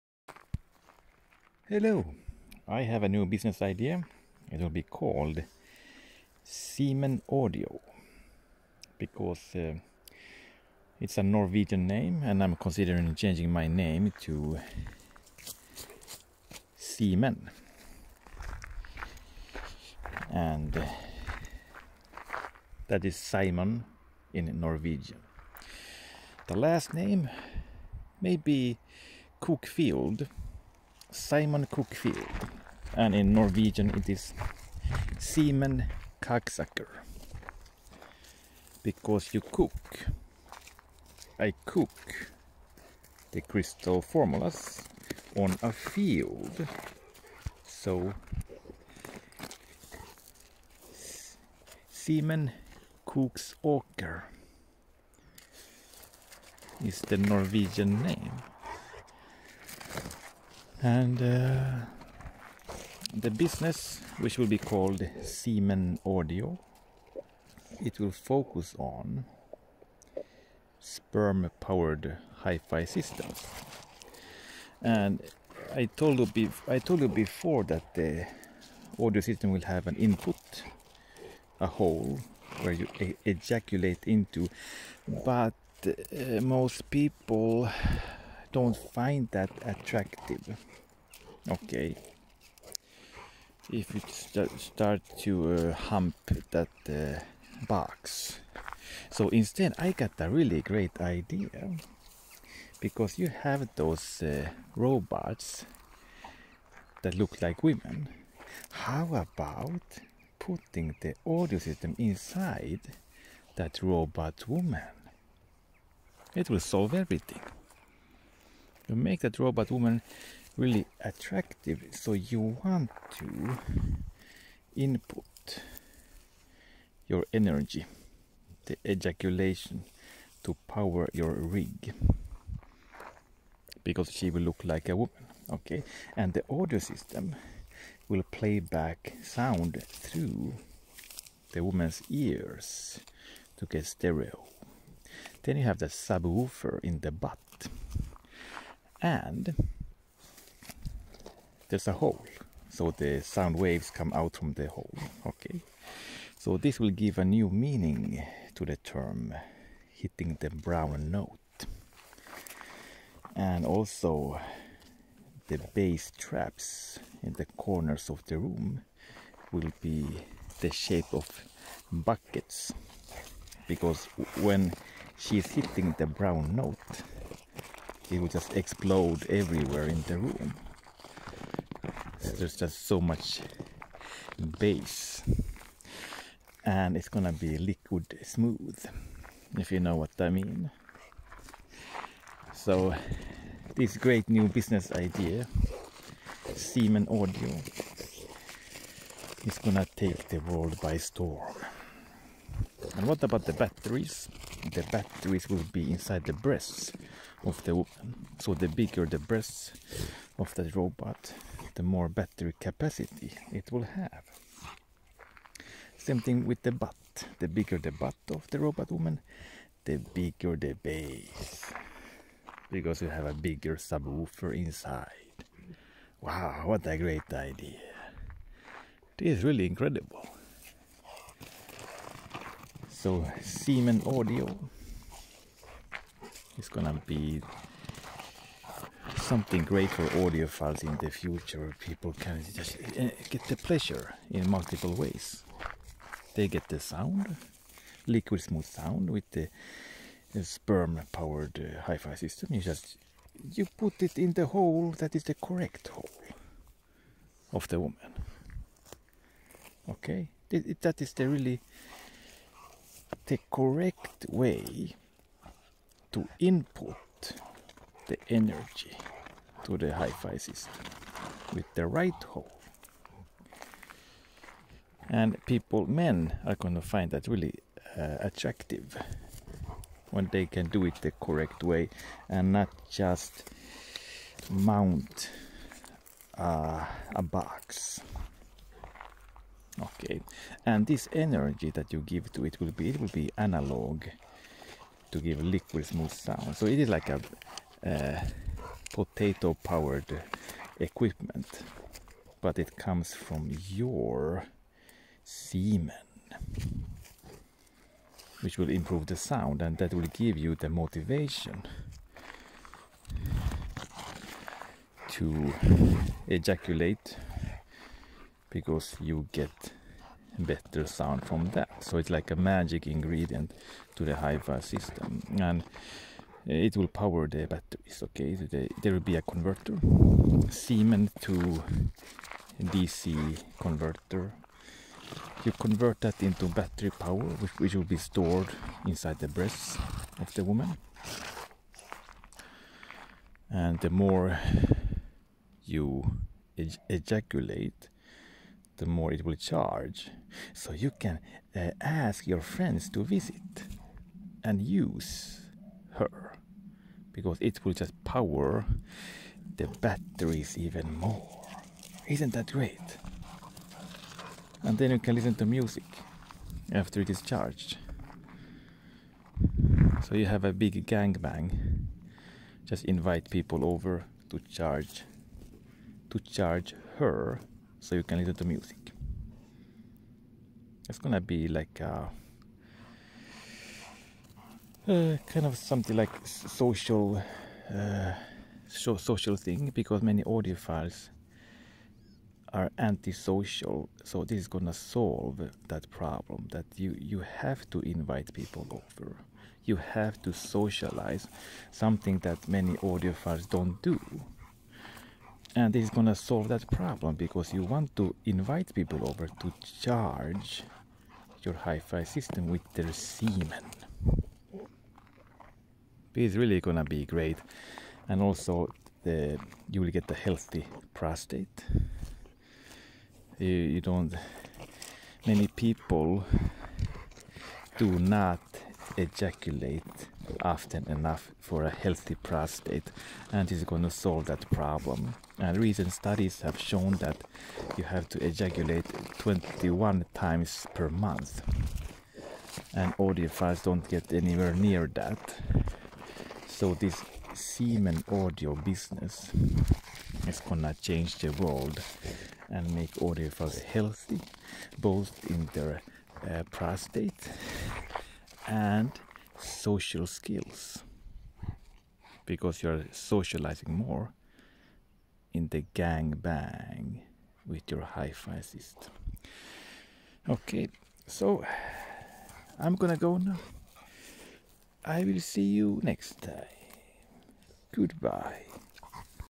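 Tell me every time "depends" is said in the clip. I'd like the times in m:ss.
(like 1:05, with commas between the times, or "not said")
not said.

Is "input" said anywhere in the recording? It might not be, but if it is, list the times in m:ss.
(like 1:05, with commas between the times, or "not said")
1:19, 2:04, 4:26.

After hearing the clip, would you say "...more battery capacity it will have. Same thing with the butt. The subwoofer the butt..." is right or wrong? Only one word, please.
wrong.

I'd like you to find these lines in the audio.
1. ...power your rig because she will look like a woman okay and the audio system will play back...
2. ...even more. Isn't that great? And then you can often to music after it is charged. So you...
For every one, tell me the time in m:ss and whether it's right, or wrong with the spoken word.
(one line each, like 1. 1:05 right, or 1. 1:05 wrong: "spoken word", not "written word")
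1. 2:10 right
2. 6:00 wrong: "listen", not "often".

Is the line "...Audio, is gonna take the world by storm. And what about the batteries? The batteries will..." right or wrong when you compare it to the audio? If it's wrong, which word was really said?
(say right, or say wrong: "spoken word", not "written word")
right.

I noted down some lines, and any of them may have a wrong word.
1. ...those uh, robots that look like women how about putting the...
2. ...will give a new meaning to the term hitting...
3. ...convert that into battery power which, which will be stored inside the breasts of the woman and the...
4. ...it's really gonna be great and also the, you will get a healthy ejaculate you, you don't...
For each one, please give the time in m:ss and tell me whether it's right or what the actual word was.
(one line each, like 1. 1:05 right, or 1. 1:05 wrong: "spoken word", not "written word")
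1. 1:43 right
2. 2:36 right
3. 5:35 right
4. 6:56 wrong: "prostate", not "ejaculate".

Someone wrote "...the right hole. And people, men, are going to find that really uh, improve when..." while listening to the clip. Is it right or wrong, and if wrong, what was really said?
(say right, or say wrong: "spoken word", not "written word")
wrong: "attractive", not "improve".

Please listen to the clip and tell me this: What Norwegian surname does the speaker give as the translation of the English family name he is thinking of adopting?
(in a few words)
Koksåker.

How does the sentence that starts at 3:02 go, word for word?
There's just so much base and it's gonna be liquid smooth if you know what I mean.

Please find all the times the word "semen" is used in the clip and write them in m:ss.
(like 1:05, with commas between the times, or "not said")
5:05, 6:52, 7:27.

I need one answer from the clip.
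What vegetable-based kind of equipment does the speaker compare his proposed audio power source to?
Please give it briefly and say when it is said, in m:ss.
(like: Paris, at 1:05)
potato powered, at 4:58.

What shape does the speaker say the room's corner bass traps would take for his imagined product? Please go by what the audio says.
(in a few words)
buckets.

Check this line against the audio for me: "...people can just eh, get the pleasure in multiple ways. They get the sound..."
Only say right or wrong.
right.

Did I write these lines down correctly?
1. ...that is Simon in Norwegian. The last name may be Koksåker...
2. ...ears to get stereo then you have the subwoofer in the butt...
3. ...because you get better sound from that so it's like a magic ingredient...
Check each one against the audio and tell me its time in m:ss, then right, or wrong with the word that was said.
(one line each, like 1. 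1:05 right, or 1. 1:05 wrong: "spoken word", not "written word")
1. 0:22 wrong: "Cookfield", not "Koksåker"
2. 2:22 right
3. 5:18 right.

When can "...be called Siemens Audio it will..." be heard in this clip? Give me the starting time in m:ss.
1:04.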